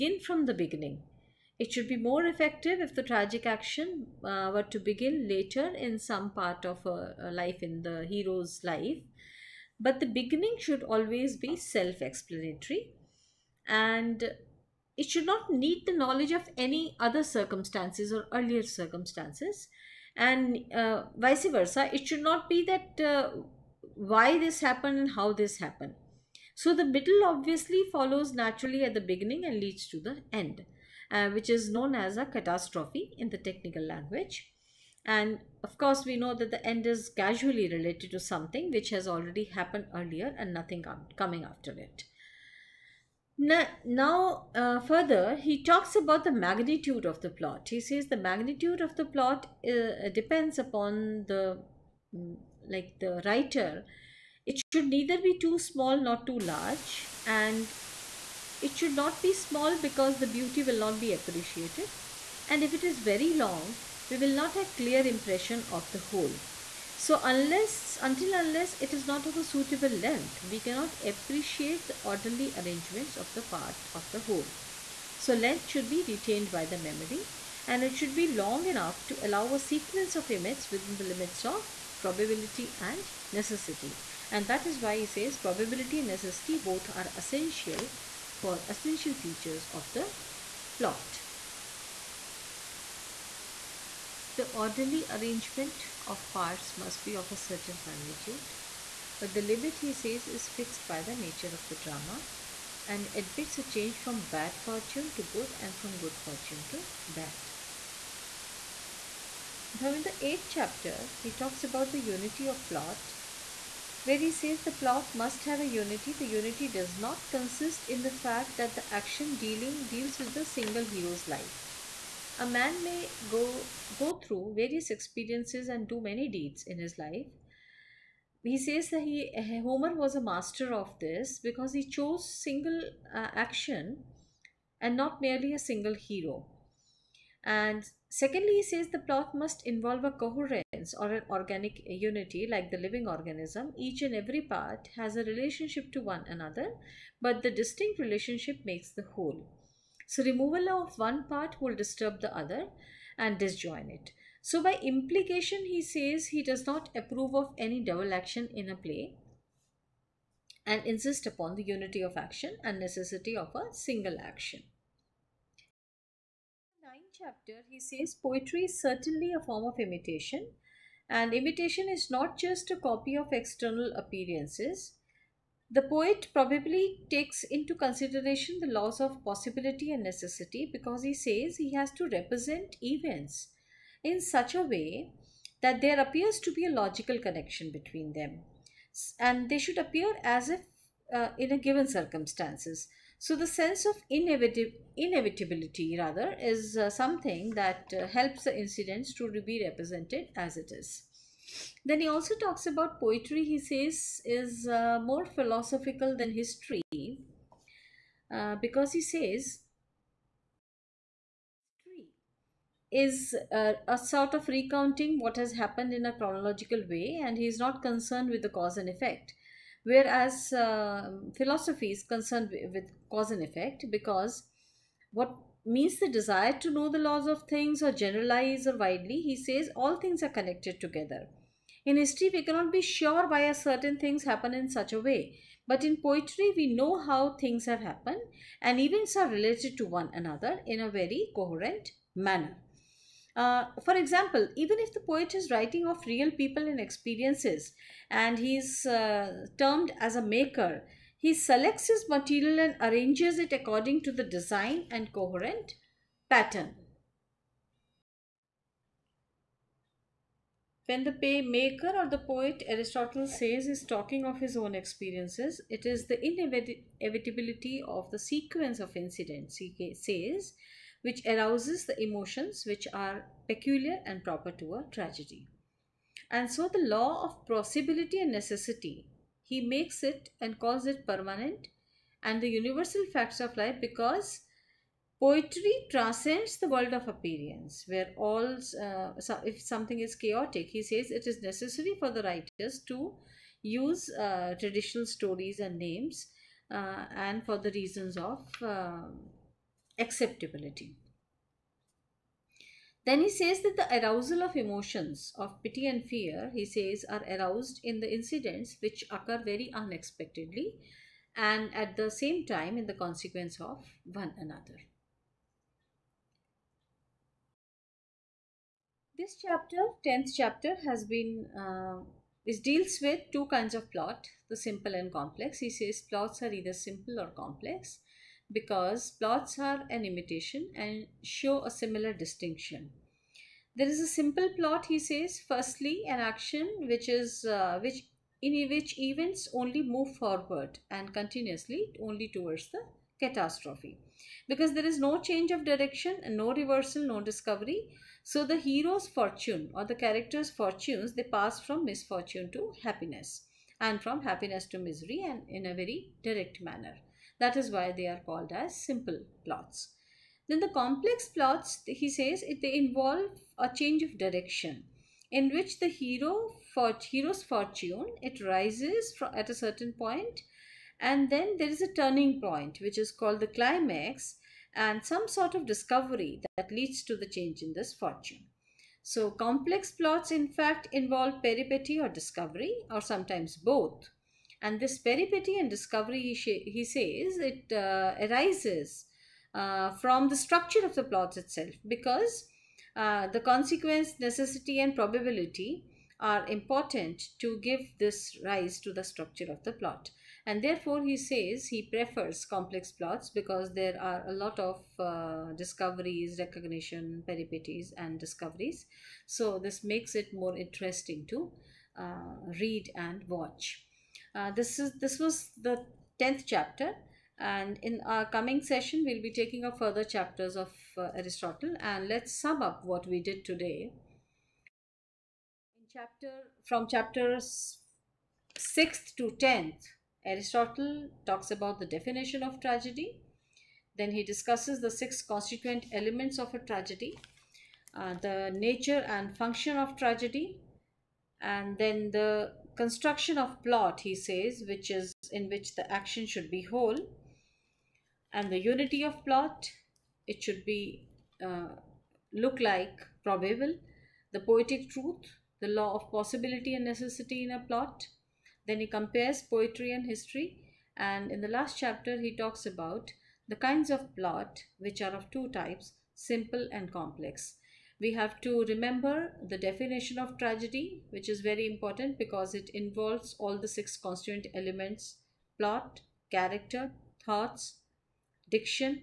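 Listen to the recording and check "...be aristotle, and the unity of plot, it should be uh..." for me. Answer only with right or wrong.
wrong.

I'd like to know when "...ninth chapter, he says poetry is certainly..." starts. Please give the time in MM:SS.
02:46.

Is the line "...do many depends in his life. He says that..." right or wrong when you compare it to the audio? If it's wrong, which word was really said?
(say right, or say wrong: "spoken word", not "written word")
wrong: "deeds", not "depends".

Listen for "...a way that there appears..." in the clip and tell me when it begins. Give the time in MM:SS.
03:04.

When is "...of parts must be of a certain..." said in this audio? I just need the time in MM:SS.
01:36.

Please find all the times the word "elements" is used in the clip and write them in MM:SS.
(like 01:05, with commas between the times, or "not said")
07:15, 07:54.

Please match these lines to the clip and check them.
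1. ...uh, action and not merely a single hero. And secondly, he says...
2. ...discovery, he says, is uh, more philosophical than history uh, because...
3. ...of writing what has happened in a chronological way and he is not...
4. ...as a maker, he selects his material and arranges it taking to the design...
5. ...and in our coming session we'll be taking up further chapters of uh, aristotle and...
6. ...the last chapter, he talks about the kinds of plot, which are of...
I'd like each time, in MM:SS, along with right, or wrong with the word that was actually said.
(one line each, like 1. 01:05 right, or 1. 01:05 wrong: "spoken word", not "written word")
1. 02:13 right
2. 03:22 wrong: "poetry", not "discovery"
3. 03:34 wrong: "recounting", not "writing"
4. 04:09 wrong: "according", not "taking"
5. 06:57 right
6. 07:41 right.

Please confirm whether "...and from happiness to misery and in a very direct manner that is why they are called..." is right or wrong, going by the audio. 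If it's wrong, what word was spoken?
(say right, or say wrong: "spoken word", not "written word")
right.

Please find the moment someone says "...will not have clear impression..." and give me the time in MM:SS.
01:04.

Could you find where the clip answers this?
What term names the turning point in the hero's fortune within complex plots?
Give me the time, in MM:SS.
06:13.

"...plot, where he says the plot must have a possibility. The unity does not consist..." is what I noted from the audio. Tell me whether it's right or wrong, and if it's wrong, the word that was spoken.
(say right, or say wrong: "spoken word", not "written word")
wrong: "unity", not "possibility".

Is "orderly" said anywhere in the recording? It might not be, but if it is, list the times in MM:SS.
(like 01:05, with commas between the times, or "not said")
01:12, 01:34.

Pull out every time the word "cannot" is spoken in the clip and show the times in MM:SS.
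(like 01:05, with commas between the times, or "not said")
01:10, 03:52.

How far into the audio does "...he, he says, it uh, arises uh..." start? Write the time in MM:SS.
06:26.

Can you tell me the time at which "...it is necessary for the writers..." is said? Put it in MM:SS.
04:51.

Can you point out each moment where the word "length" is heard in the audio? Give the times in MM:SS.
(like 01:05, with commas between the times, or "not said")
01:09, 01:15.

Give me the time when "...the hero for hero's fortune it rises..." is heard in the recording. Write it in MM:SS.
06:05.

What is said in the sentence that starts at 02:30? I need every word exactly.
So, removal of one part will disturb the other, and disjoin it.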